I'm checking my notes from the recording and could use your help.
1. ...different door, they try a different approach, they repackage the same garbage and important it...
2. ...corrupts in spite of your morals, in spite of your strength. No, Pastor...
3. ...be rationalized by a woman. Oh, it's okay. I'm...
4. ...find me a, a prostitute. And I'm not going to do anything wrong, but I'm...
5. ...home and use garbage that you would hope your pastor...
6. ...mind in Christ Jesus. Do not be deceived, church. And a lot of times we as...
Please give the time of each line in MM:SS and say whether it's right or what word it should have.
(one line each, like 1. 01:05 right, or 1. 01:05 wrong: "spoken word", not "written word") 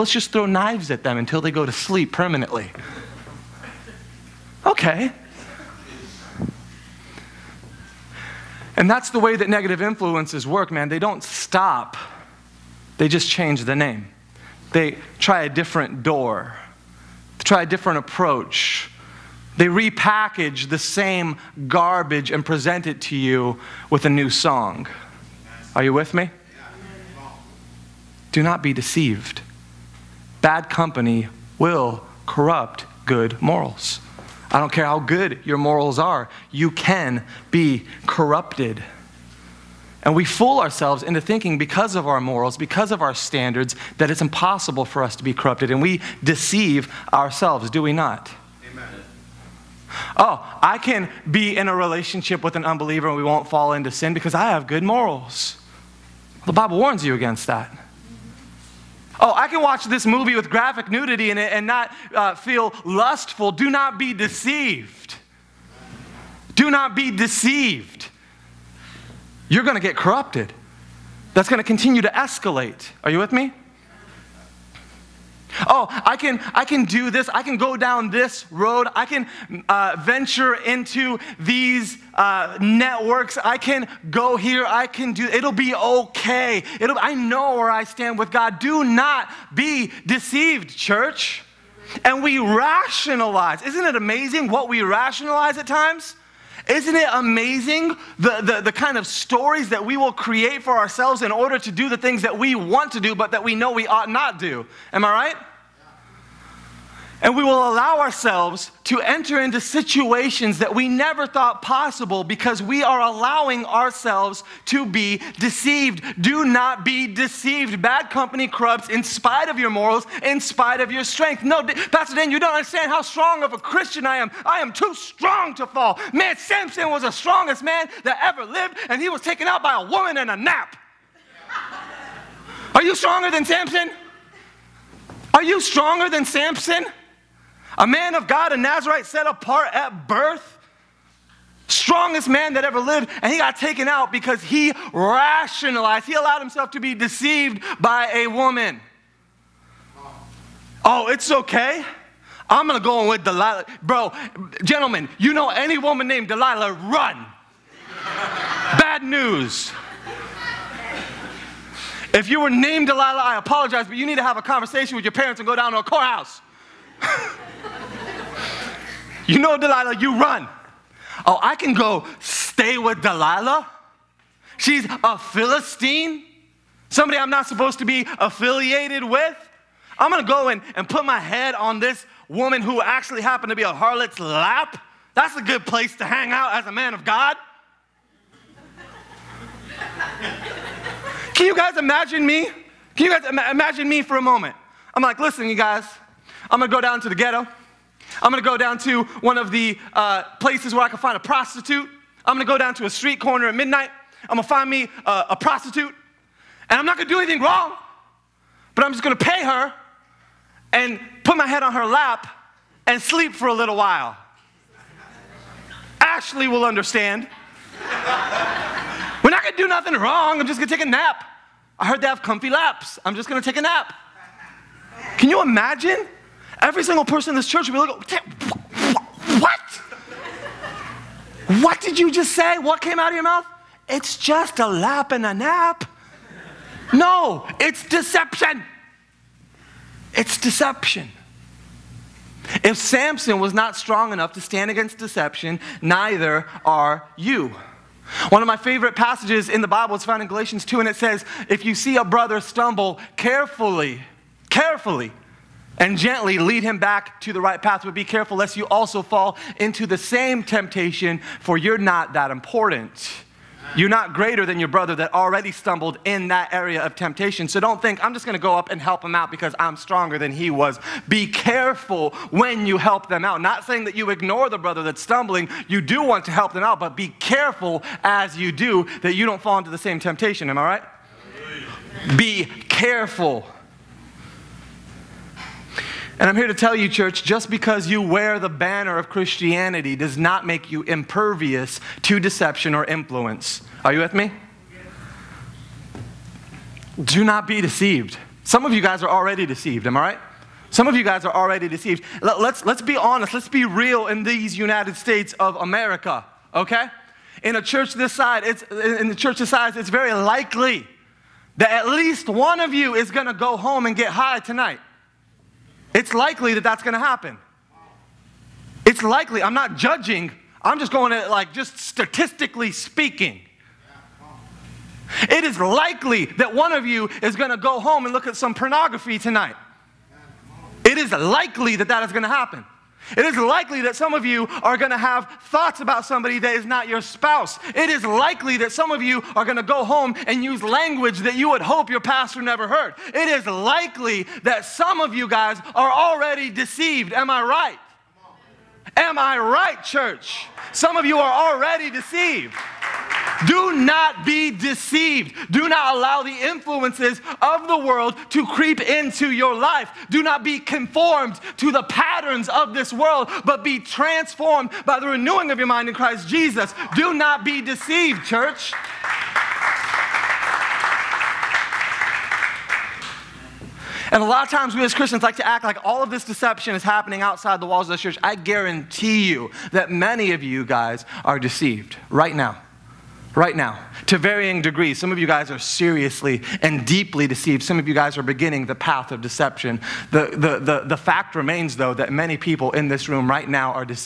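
1. 00:15 wrong: "present", not "important"
2. 01:58 right
3. 02:26 wrong: "deceived", not "rationalized"
4. 03:24 right
5. 05:39 wrong: "language", not "garbage"
6. 06:05 right.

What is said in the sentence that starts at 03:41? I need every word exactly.
I heard they have comfy laps.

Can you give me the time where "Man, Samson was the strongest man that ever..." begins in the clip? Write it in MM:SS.
02:06.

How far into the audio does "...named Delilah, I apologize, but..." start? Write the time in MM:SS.
02:42.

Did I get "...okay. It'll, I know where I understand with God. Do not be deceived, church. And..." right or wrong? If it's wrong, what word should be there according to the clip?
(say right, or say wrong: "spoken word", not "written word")
wrong: "stand", not "understand".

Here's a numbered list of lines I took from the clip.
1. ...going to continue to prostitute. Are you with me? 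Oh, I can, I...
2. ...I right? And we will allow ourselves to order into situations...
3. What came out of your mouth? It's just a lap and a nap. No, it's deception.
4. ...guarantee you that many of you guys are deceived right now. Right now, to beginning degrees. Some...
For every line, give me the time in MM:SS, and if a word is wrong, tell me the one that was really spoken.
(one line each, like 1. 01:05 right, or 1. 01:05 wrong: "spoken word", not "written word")
1. 01:11 wrong: "escalate", not "prostitute"
2. 01:45 wrong: "enter", not "order"
3. 03:52 right
4. 06:18 wrong: "varying", not "beginning".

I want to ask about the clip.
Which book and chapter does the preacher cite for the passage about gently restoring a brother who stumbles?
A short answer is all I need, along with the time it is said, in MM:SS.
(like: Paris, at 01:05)
Galatians 2, at 04:10.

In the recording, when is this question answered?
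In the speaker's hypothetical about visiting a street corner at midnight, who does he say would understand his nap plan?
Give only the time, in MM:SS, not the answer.
03:35.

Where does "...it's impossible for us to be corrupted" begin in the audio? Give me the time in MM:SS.
00:44.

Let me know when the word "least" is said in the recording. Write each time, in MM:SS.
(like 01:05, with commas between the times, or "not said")
05:11.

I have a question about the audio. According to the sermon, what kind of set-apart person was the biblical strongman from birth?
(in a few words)
Nazarite.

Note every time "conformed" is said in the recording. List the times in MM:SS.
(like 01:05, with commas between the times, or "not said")
06:00.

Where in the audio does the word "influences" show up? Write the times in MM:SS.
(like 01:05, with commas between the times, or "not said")
00:09, 04:52, 05:56.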